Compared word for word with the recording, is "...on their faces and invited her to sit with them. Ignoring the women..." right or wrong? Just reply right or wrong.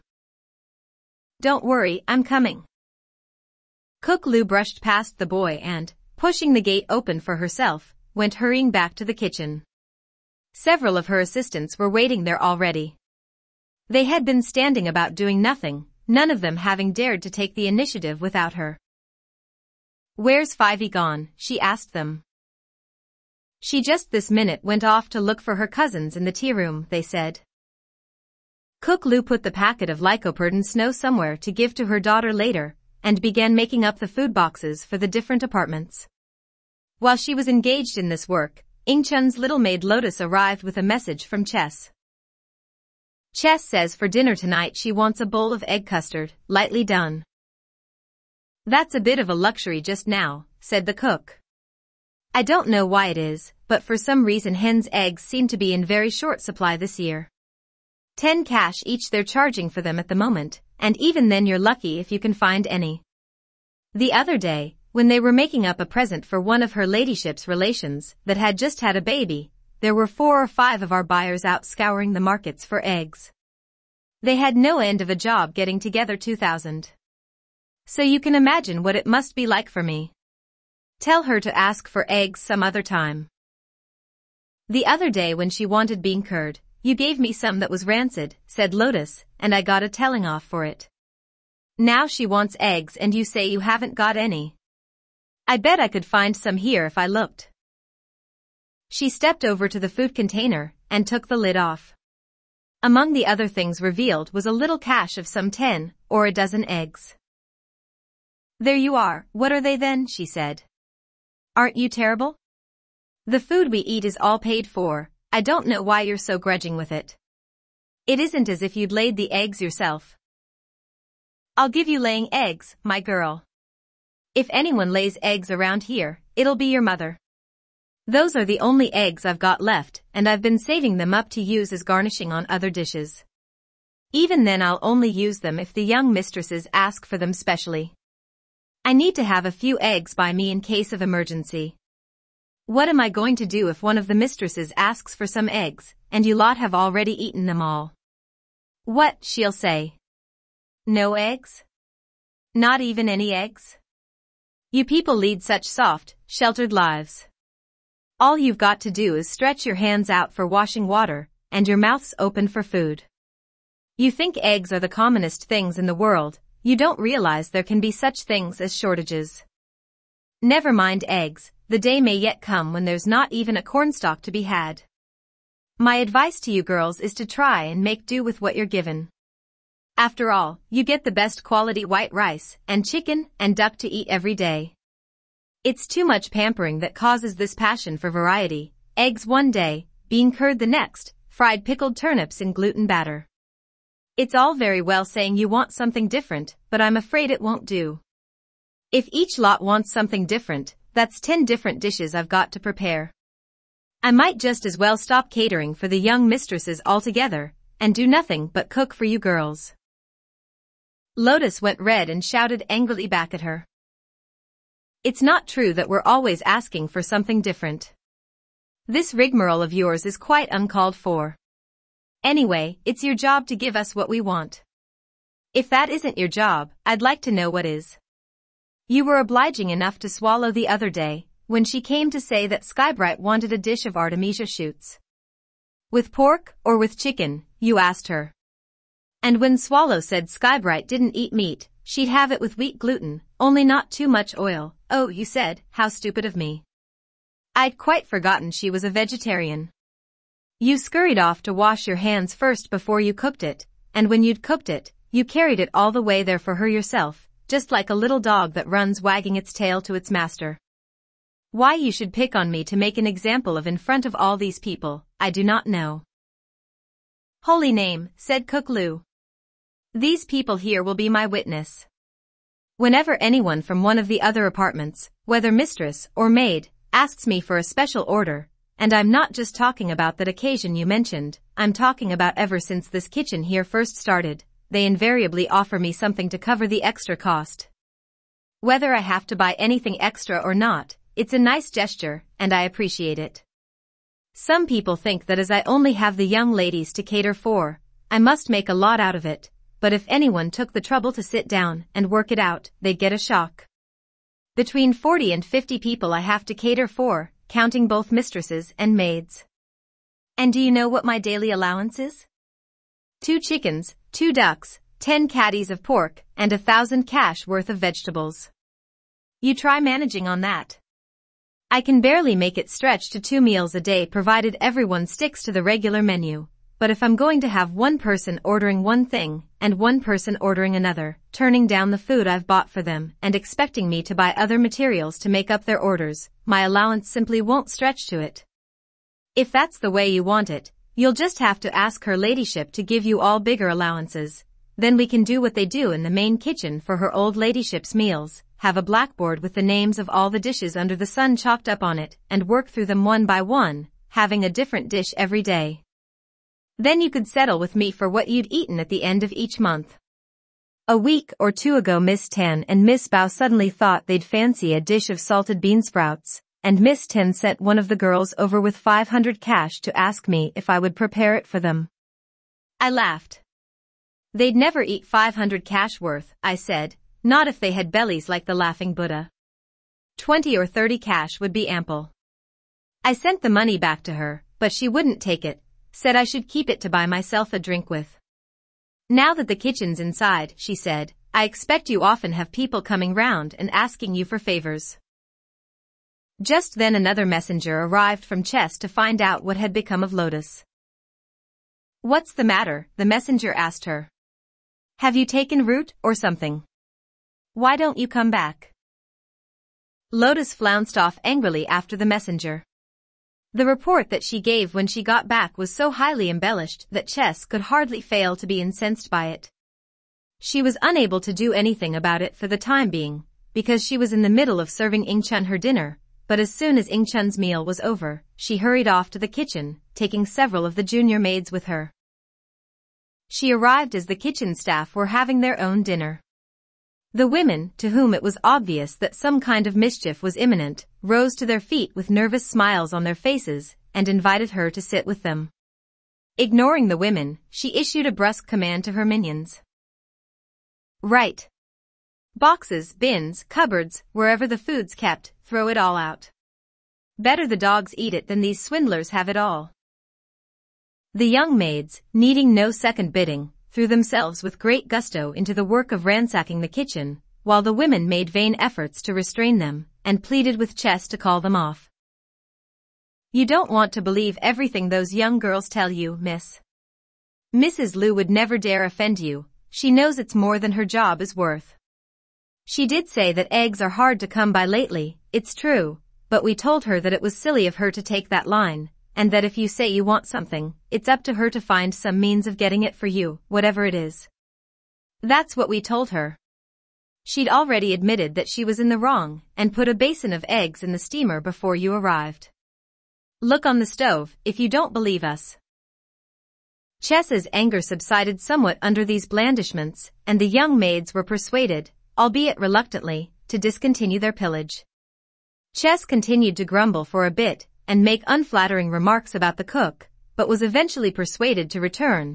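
right.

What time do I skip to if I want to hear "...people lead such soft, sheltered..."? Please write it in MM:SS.
02:34.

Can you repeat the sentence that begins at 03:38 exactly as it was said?
This rigmarole of yours is quite uncalled for.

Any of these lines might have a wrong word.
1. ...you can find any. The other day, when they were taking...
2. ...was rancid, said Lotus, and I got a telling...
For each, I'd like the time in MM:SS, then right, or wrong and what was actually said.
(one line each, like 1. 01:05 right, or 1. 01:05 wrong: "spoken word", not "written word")
1. 01:02 wrong: "making", not "taking"
2. 01:27 right.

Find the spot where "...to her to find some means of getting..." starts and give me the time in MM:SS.
08:11.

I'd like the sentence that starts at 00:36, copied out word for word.
While she was engaged in this work, Ying Chun's little maid Lotus arrived with a message from Chess.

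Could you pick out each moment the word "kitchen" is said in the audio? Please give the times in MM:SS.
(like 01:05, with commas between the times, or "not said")
00:09, 04:43, 05:46, 06:29, 07:09, 07:14, 07:46.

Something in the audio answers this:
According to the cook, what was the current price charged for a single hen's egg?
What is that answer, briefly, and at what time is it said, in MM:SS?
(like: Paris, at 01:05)
10 cash, at 00:58.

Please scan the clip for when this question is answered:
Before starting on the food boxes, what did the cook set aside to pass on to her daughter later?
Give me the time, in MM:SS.
00:30.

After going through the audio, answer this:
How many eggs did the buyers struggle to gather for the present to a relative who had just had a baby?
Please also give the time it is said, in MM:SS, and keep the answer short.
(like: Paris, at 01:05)
2000, at 01:16.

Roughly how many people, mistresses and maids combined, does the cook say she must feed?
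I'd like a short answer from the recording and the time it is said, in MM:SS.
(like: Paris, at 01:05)
Between 40 and 50, at 05:04.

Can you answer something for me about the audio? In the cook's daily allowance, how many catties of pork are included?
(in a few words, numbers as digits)
10.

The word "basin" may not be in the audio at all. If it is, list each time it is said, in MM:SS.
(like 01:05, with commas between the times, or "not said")
08:19.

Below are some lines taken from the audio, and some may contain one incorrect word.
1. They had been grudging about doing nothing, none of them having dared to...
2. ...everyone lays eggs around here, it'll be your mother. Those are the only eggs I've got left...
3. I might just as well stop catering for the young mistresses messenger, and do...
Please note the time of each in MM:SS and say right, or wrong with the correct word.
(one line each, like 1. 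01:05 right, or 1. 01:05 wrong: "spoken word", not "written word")
1. 00:13 wrong: "standing", not "grudging"
2. 02:04 wrong: "anyone", not "everyone"
3. 03:24 wrong: "altogether", not "messenger".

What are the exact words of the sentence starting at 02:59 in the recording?
After all, you get the best quality white rice and chicken and duck to eat every day.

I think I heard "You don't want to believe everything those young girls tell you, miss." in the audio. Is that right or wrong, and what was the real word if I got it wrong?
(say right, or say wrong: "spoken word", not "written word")
right.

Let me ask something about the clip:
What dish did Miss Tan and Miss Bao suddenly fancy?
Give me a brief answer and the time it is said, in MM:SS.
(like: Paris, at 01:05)
salted bean sprouts, at 06:05.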